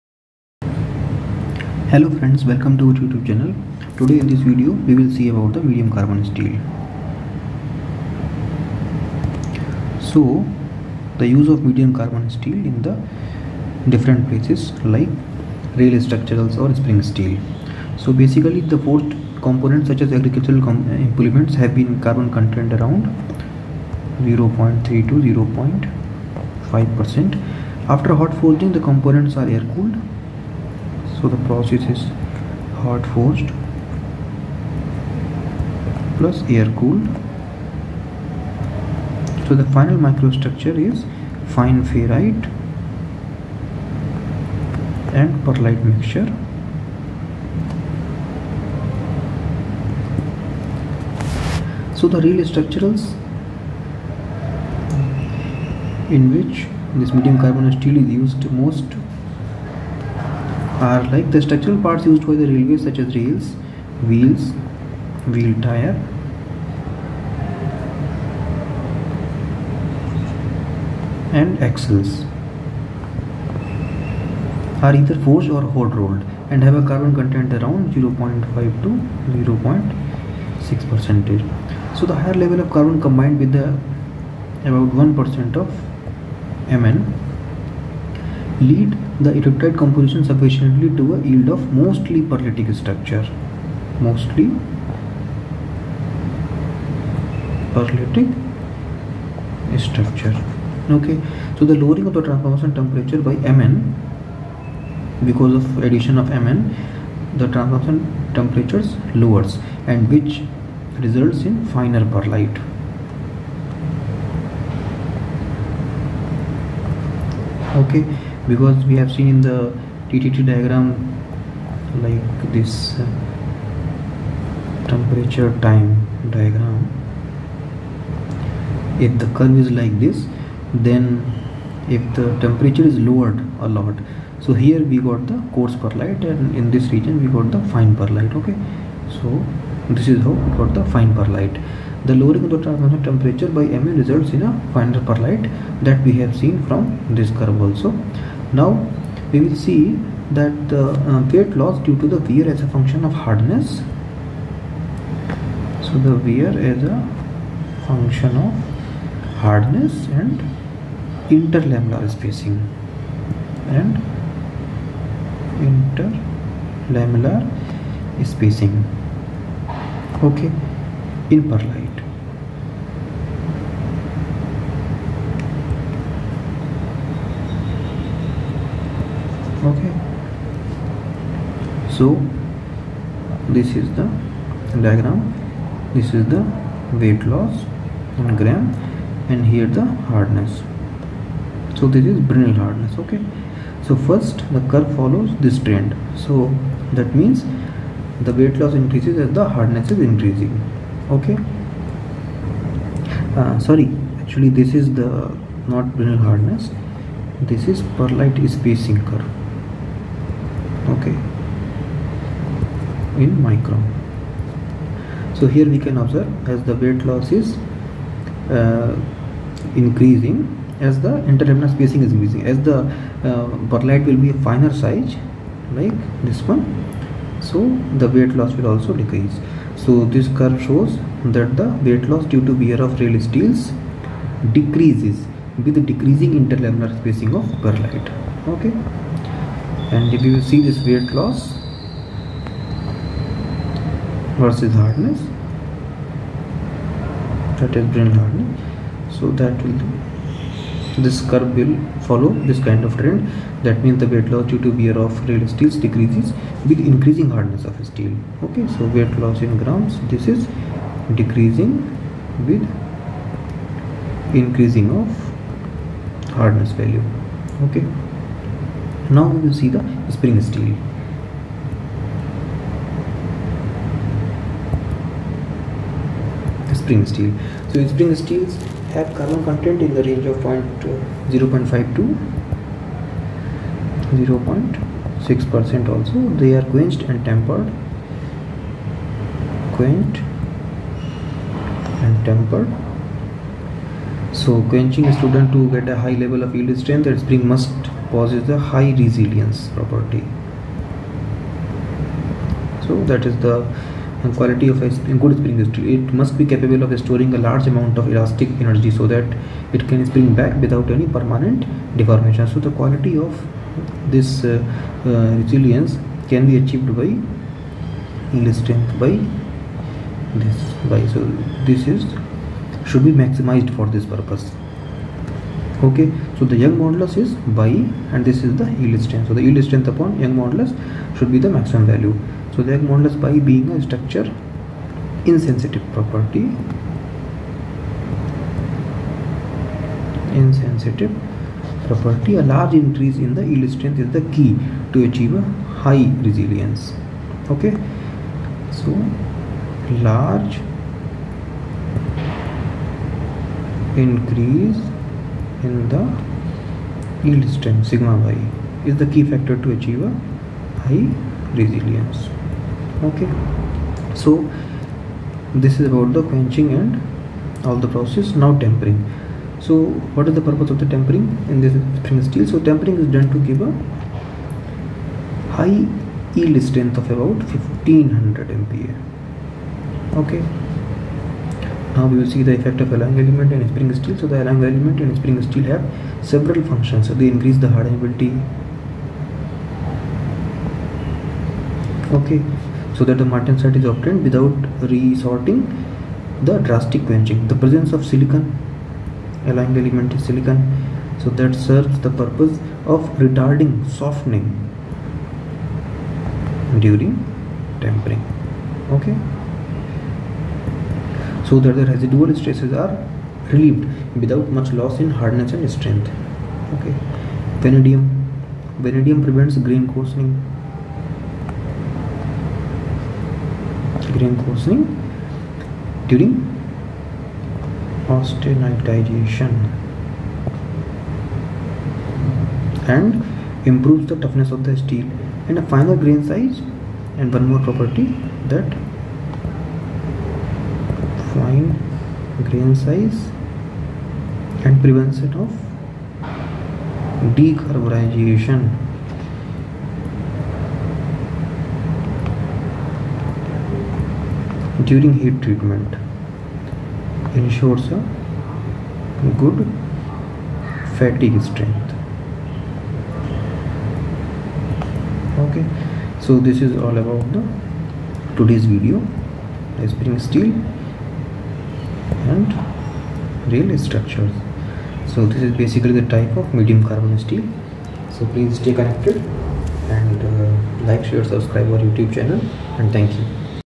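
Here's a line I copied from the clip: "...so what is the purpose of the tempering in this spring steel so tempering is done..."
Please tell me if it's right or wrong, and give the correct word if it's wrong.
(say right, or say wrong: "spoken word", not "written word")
right.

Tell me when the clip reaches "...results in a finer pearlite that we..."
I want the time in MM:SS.
02:24.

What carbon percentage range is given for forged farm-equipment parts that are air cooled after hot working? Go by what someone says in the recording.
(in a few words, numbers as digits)
0.3 to 0.5 percent.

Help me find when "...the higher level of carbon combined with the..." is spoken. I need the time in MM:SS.
01:22.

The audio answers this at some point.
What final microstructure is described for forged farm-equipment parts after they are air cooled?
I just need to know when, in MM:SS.
00:41.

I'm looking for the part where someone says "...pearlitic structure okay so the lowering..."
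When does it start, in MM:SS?
01:37.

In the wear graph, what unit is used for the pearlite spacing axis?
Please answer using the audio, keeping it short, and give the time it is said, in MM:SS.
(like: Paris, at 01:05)
micron, at 03:33.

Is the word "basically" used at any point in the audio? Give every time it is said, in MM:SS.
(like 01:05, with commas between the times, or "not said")
00:18, 07:55.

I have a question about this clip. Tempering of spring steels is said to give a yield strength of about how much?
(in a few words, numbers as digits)
1500 MPa.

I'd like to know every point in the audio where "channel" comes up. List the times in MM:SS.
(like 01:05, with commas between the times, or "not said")
00:03, 08:02.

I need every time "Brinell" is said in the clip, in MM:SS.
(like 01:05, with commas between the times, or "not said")
03:12, 03:25, 04:07.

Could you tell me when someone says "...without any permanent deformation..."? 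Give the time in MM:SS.
05:10.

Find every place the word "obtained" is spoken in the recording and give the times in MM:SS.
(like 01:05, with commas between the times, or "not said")
06:33.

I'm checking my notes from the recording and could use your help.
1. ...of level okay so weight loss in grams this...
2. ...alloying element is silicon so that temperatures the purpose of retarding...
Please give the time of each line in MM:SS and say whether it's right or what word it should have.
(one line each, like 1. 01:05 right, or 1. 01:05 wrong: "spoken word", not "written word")
1. 04:17 wrong: "steel", not "level"
2. 06:39 wrong: "serves", not "temperatures".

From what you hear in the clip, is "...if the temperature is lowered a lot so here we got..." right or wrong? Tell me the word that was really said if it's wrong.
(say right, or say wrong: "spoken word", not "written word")
right.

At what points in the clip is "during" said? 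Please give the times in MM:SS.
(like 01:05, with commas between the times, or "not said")
06:46, 07:06, 07:34.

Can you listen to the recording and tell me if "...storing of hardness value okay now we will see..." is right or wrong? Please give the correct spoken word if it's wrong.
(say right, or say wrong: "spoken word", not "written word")
wrong: "increasing", not "storing".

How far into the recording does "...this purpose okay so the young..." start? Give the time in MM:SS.
05:23.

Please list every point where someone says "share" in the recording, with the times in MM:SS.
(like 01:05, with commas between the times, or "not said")
08:01.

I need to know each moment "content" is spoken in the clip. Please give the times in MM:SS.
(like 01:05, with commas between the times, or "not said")
00:22, 01:17, 04:39.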